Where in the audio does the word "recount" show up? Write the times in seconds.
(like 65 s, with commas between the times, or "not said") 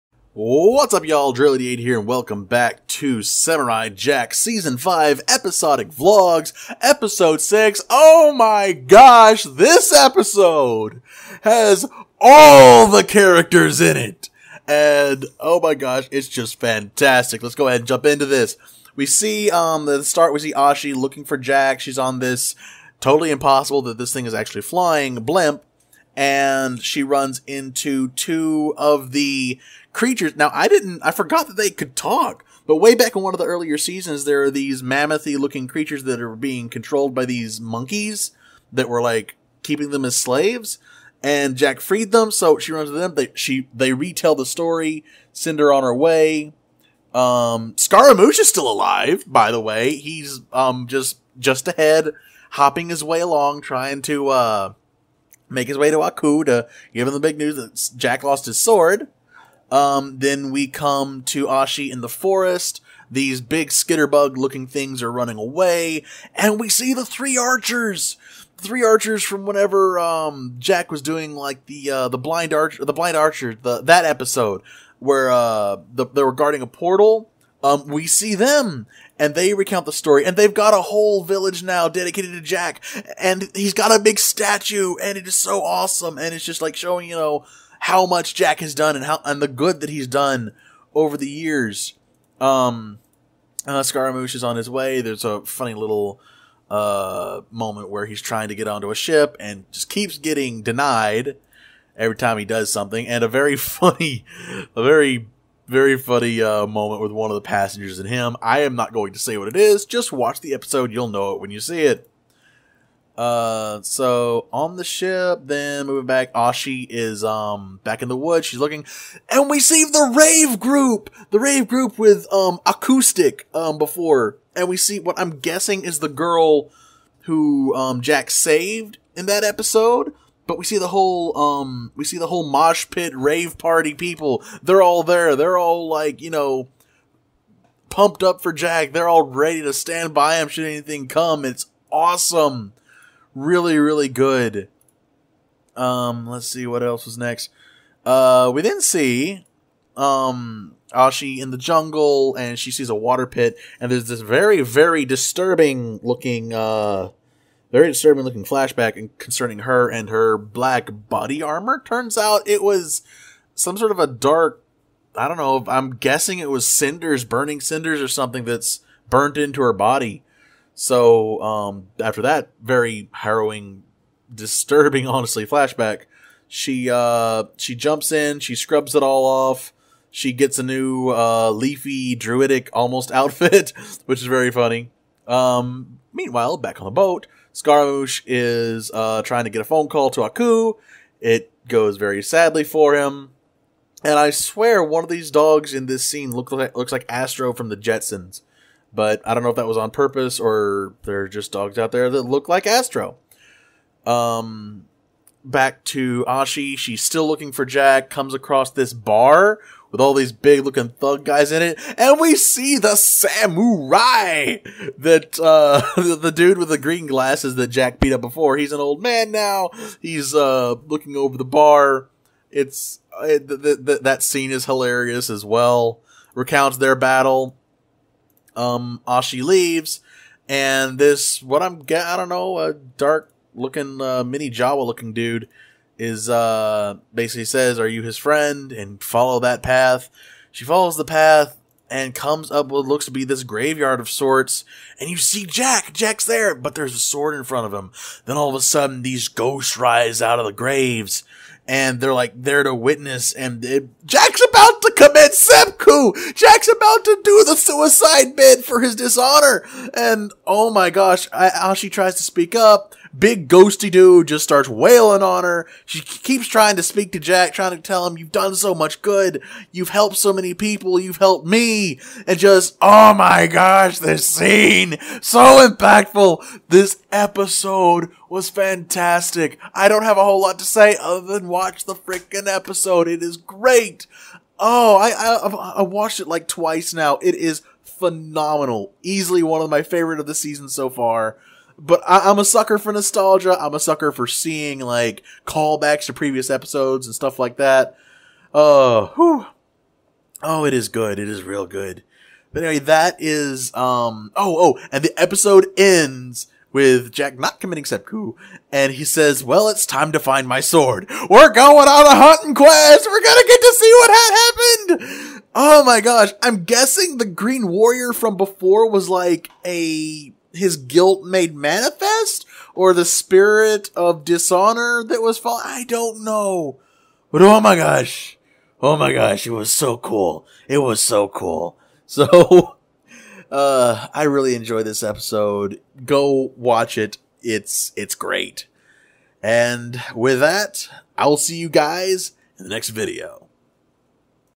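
79 s, 226 s.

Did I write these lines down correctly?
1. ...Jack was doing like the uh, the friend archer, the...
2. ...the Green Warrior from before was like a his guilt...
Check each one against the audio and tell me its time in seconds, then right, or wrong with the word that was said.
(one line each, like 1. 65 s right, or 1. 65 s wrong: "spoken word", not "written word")
1. 70 s wrong: "blind", not "friend"
2. 317 s right.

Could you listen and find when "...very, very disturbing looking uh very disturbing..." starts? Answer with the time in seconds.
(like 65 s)
154 s.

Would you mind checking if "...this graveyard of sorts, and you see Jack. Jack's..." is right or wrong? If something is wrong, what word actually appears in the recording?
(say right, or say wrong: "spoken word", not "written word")
right.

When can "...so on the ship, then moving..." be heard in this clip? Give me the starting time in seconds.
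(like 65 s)
113 s.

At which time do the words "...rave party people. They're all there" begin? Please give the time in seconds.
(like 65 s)
133 s.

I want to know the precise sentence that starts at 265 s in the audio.
She keeps trying to speak to Jack, trying to tell him, you've done so much good.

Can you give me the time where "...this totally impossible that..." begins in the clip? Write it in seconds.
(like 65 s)
22 s.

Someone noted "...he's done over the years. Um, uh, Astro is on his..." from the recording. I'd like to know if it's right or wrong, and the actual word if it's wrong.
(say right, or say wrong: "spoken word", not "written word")
wrong: "Scaramouche", not "Astro".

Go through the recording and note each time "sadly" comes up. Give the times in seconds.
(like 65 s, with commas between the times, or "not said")
192 s.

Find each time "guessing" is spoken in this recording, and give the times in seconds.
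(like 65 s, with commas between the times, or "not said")
125 s, 165 s, 316 s.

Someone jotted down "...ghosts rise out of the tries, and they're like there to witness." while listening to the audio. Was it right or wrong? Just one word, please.
wrong.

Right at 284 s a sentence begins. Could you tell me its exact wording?
Oh, I, I, I watched it like twice now.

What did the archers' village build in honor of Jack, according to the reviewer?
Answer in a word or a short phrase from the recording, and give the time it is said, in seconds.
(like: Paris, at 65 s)
A big statue, at 84 s.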